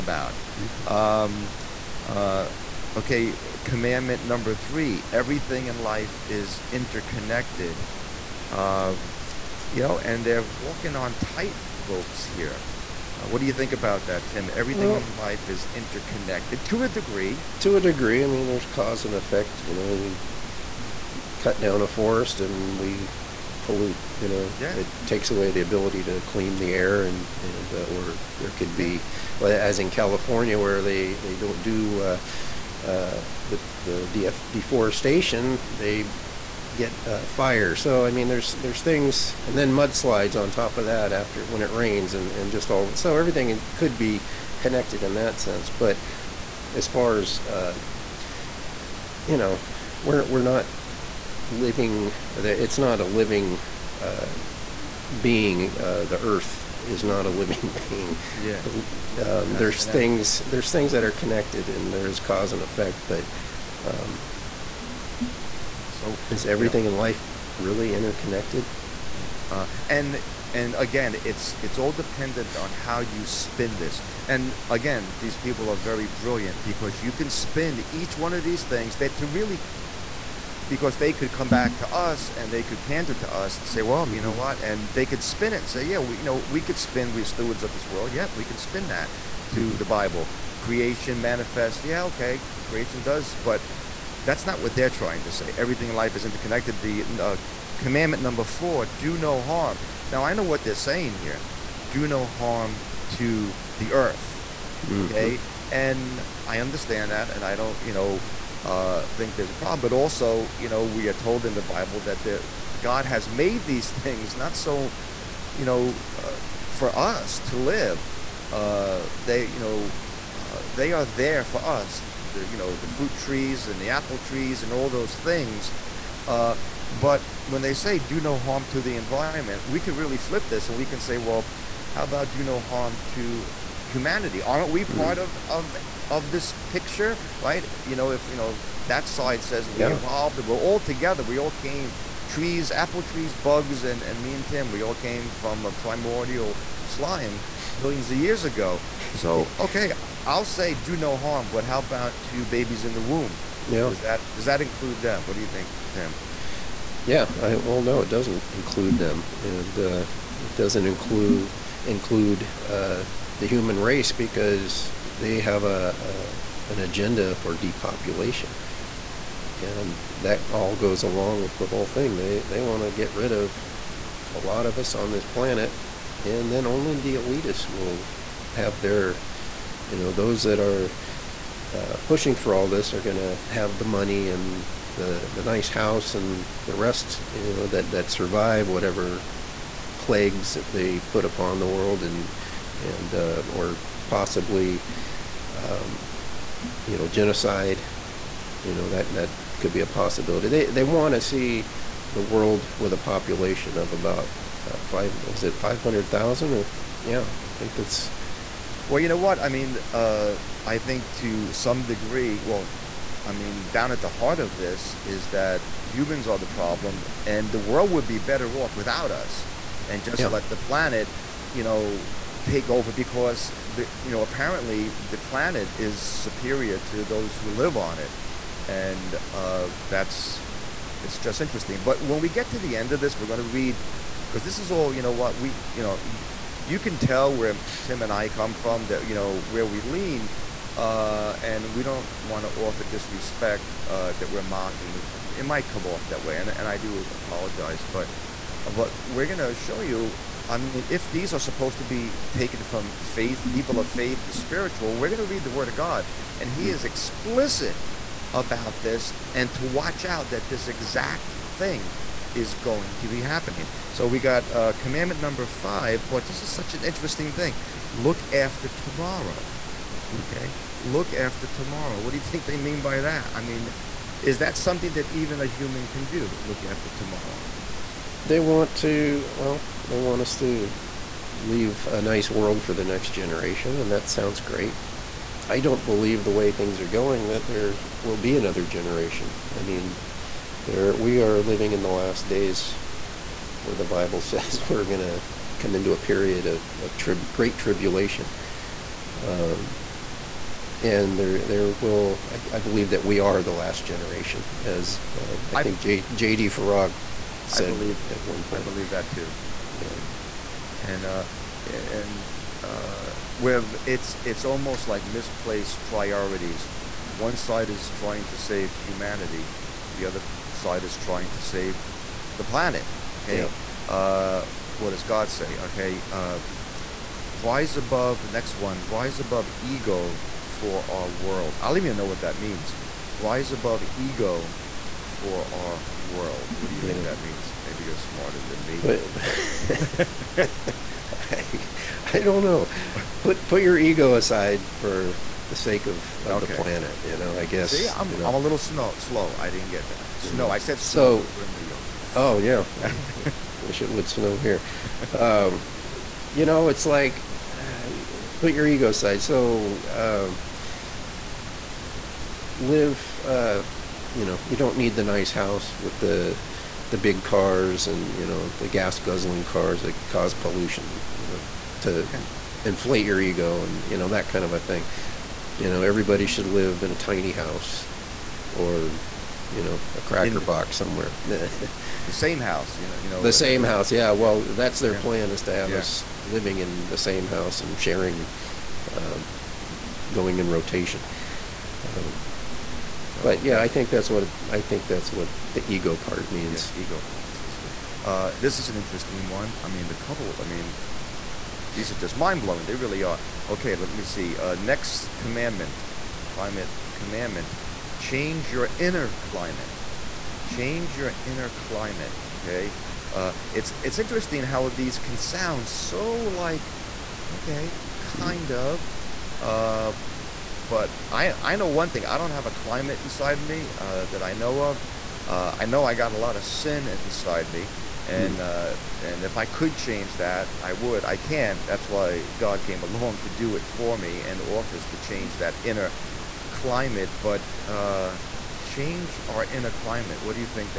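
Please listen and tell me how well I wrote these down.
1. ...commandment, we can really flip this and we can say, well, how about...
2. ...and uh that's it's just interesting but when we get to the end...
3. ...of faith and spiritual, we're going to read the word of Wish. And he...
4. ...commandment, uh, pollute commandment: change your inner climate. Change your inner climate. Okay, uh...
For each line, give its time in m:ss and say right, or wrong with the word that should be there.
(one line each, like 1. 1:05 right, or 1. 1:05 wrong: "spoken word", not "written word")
1. 2:08 wrong: "environment", not "commandment"
2. 3:48 right
3. 4:13 wrong: "God", not "Wish"
4. 6:45 wrong: "climate", not "pollute".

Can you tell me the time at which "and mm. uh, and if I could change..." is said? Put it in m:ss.
7:08.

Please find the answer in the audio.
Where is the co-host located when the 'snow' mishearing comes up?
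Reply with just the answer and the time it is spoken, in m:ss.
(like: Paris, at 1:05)
New York, at 5:51.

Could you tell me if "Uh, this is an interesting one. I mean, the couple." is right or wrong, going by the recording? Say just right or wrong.
right.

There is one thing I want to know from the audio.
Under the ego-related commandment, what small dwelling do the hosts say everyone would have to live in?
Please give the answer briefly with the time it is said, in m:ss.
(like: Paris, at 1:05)
A tiny house, at 6:16.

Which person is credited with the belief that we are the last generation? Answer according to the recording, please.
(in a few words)
JD Farag.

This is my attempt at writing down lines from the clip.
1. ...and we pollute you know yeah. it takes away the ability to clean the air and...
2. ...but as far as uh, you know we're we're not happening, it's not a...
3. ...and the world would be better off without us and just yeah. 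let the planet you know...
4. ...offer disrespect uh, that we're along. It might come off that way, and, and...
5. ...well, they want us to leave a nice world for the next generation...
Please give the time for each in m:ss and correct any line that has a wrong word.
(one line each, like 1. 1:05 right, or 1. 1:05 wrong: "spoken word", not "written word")
1. 0:22 right
2. 0:45 wrong: "living", not "happening"
3. 3:37 right
4. 4:02 wrong: "mocking", not "along"
5. 4:39 right.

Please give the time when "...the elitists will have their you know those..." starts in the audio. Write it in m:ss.
2:56.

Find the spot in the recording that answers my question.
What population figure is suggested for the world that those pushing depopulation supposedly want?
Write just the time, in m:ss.
3:25.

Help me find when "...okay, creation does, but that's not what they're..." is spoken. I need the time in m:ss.
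1:32.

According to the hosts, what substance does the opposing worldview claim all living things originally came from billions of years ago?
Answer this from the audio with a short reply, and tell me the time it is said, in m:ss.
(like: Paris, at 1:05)
Primordial slime, at 2:25.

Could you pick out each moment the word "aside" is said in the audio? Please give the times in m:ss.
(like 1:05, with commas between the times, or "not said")
5:44, 5:58.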